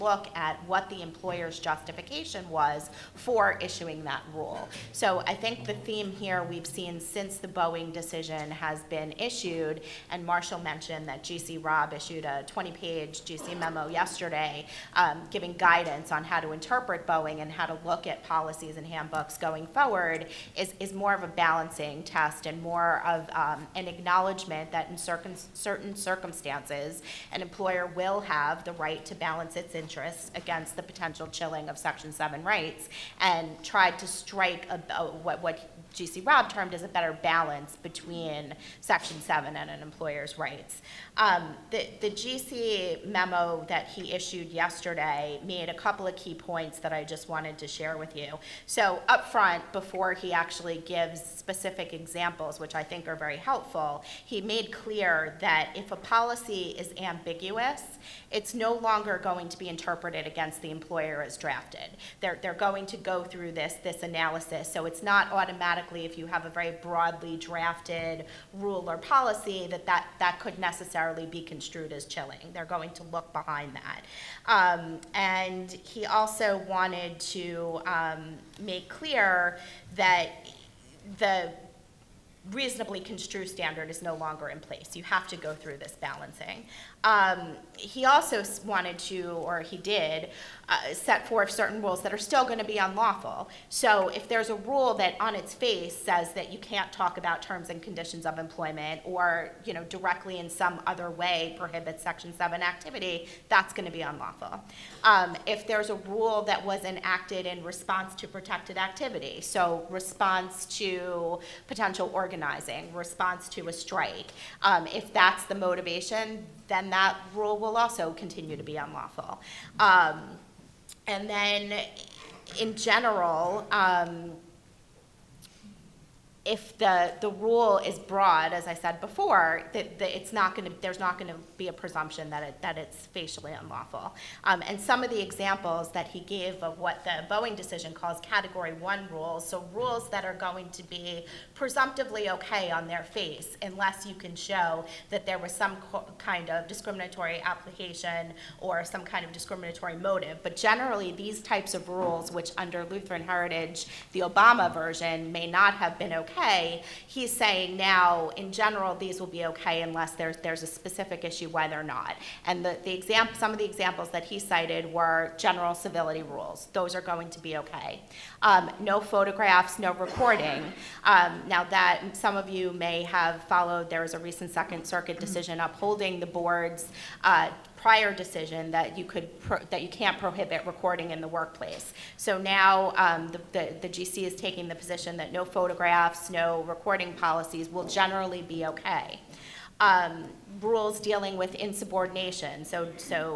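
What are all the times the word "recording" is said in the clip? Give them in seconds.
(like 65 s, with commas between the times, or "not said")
169 s, 180 s, 186 s.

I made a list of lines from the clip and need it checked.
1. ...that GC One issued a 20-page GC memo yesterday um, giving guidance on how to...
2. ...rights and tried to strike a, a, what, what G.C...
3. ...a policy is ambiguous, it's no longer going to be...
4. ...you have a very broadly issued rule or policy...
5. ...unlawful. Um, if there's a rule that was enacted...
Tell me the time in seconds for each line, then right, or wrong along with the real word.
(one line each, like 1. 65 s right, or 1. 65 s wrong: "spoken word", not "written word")
1. 11 s wrong: "Robb", not "One"
2. 32 s right
3. 55 s right
4. 66 s wrong: "drafted", not "issued"
5. 104 s right.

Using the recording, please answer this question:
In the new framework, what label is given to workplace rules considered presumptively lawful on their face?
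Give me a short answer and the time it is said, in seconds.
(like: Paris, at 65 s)
Category One, at 138 s.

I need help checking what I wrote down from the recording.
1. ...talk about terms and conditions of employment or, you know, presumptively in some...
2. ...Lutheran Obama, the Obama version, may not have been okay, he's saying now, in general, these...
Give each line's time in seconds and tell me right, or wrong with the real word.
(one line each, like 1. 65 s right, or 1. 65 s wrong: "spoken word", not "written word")
1. 96 s wrong: "directly", not "presumptively"
2. 152 s wrong: "Heritage", not "Obama".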